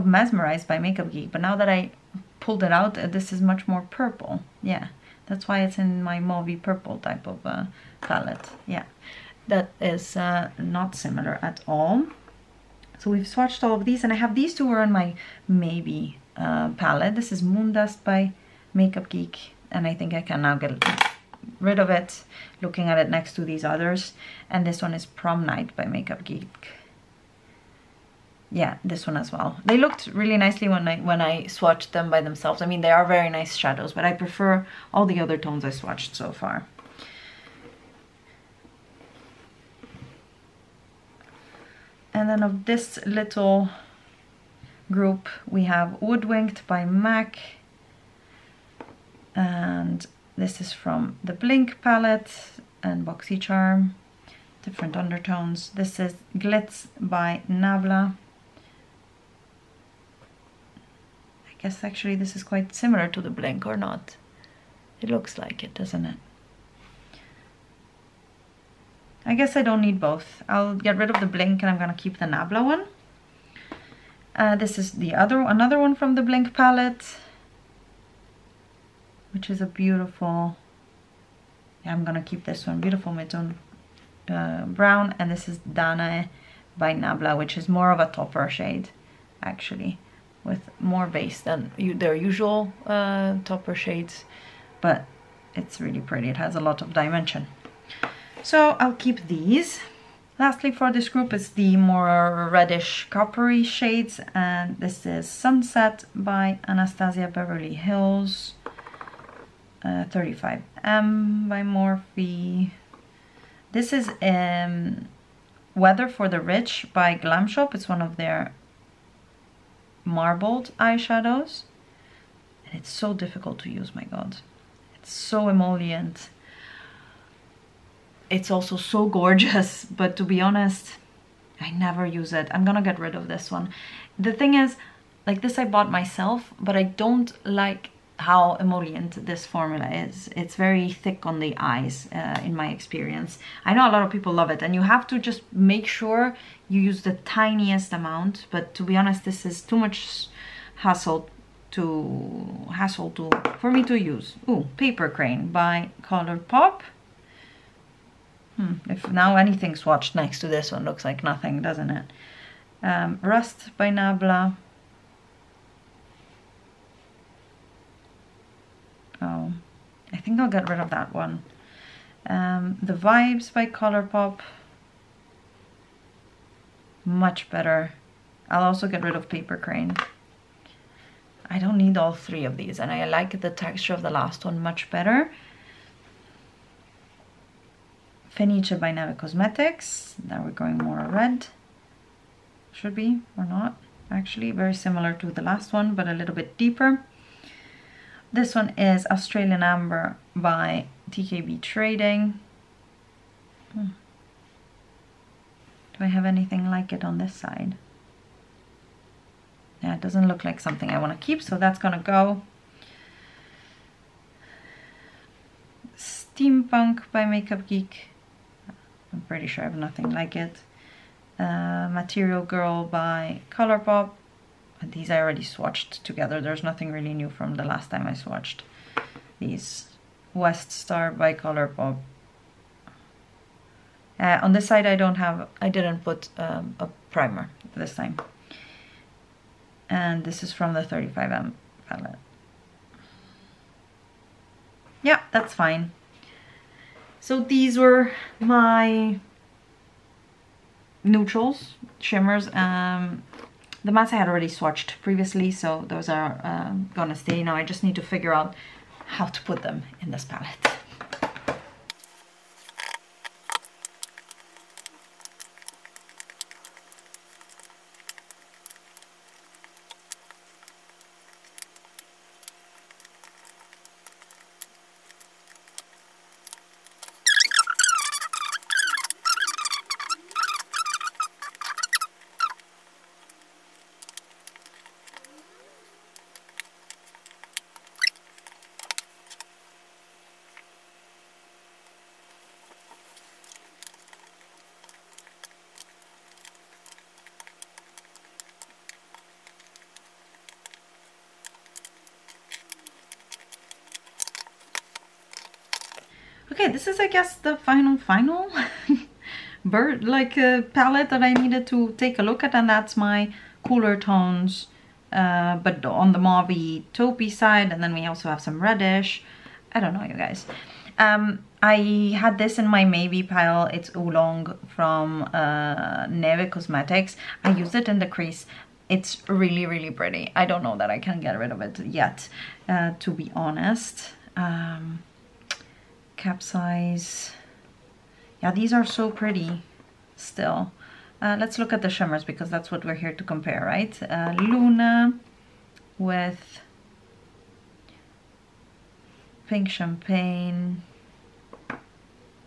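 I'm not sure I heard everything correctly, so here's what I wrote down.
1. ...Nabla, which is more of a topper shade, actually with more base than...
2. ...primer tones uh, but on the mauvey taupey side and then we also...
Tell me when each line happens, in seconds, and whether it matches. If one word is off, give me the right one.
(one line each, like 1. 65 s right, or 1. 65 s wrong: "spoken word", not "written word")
1. 86 s right
2. 313 s wrong: "cooler", not "primer".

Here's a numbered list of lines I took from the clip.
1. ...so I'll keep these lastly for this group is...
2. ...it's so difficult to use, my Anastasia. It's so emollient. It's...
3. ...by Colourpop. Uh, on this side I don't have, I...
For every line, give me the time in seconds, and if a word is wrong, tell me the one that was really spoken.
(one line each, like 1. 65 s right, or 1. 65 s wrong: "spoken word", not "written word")
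1. 98 s right
2. 122 s wrong: "God", not "Anastasia"
3. 231 s right.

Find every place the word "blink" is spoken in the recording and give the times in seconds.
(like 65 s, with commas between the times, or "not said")
51 s, 63 s, 71 s, 76 s.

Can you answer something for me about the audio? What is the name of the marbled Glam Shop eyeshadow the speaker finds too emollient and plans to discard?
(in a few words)
Weather for the Rich.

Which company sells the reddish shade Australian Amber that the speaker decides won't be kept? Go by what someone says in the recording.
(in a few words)
TKB Trading.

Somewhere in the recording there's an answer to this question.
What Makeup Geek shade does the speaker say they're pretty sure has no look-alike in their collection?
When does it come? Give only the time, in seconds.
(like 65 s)
215 s.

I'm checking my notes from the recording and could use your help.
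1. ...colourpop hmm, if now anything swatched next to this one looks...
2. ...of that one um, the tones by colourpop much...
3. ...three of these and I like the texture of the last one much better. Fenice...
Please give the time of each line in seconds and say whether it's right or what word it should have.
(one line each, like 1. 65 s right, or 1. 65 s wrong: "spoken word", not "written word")
1. 156 s right
2. 170 s wrong: "vibes", not "tones"
3. 182 s right.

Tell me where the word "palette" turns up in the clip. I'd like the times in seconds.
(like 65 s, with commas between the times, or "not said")
8 s, 16 s, 51 s, 76 s, 241 s, 260 s, 310 s.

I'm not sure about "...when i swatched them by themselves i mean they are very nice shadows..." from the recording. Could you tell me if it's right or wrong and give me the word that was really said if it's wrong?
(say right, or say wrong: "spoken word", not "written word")
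right.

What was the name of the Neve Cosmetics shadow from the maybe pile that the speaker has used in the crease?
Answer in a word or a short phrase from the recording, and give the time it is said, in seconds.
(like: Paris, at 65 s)
Oolong, at 323 s.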